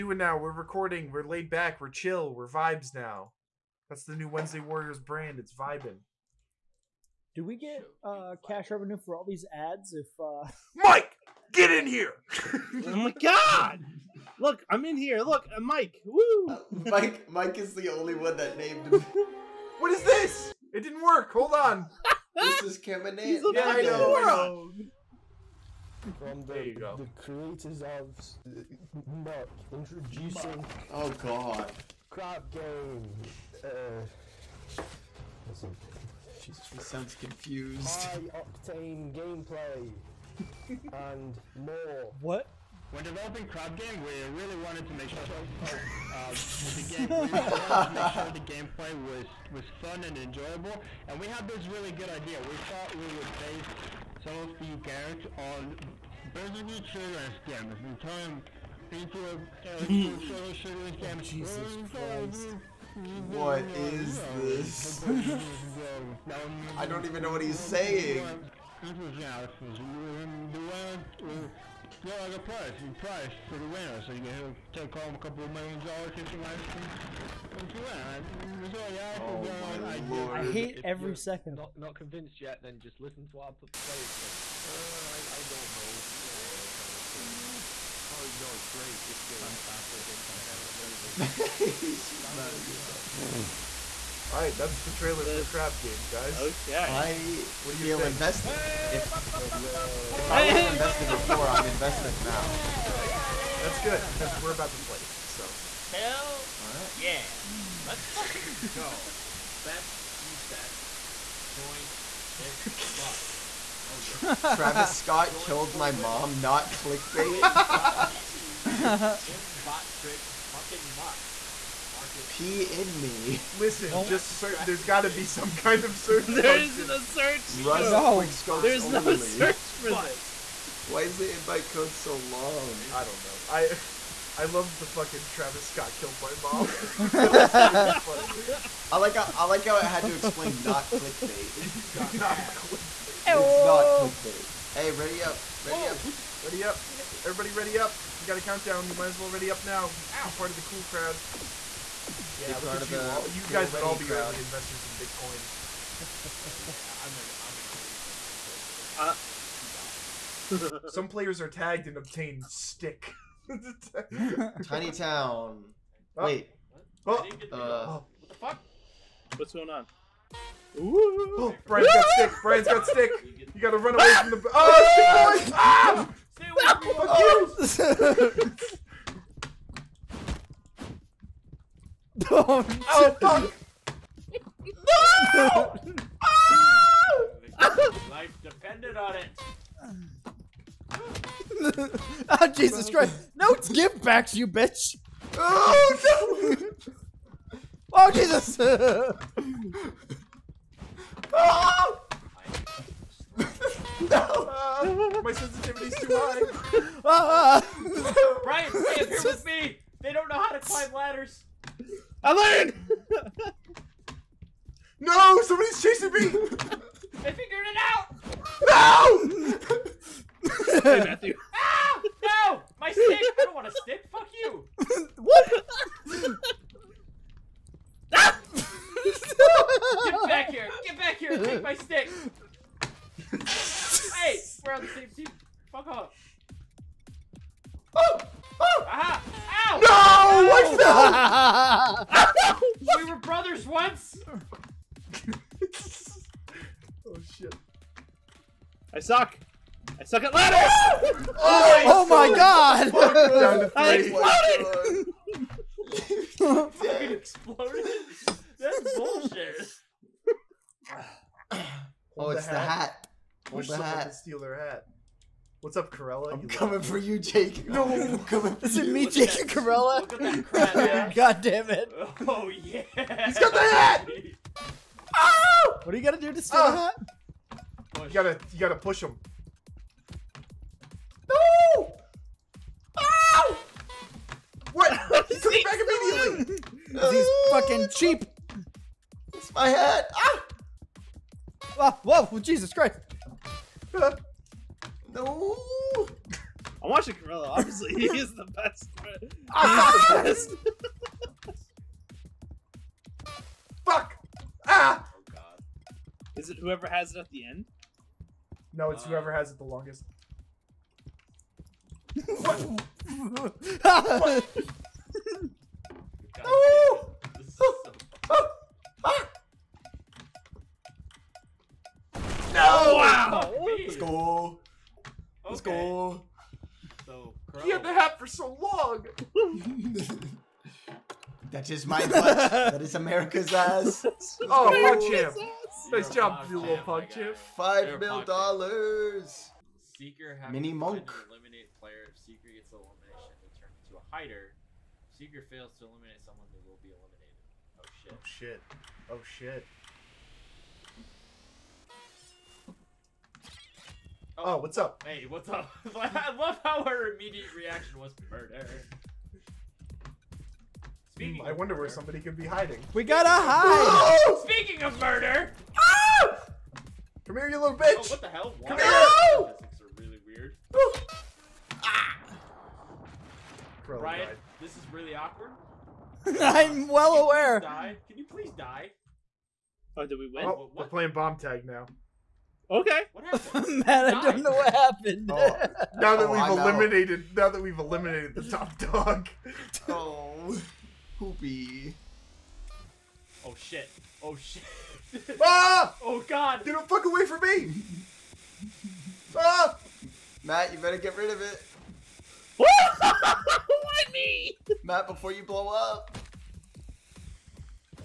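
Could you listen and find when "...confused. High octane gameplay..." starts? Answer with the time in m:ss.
0:37.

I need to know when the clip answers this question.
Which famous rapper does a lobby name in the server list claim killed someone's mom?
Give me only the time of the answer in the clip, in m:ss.
2:15.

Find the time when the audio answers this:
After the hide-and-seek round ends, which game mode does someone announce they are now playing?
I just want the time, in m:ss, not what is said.
6:21.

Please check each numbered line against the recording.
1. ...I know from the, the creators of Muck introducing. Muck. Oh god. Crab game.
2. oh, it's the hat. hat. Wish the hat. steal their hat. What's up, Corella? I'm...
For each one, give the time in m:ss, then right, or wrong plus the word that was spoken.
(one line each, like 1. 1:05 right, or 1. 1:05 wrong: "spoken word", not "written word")
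1. 0:23 right
2. 4:22 right.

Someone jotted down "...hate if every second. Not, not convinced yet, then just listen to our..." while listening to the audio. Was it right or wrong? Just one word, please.
right.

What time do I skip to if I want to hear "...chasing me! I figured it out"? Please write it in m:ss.
3:35.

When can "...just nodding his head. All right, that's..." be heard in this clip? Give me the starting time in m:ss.
1:32.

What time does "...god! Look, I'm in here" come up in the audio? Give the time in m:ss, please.
0:13.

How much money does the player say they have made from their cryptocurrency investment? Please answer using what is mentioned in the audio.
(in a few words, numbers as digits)
2 dollars.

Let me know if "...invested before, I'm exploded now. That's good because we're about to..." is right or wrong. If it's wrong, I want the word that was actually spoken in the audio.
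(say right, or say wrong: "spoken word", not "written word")
wrong: "invested", not "exploded".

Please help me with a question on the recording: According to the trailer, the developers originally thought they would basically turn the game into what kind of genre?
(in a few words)
a shooter.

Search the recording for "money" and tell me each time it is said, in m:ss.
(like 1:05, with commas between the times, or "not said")
not said.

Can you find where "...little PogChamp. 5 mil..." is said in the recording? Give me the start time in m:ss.
5:36.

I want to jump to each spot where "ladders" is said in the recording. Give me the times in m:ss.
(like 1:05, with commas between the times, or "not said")
3:30, 4:10.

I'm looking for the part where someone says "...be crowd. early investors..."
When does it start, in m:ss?
2:33.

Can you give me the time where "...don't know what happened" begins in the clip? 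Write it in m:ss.
6:24.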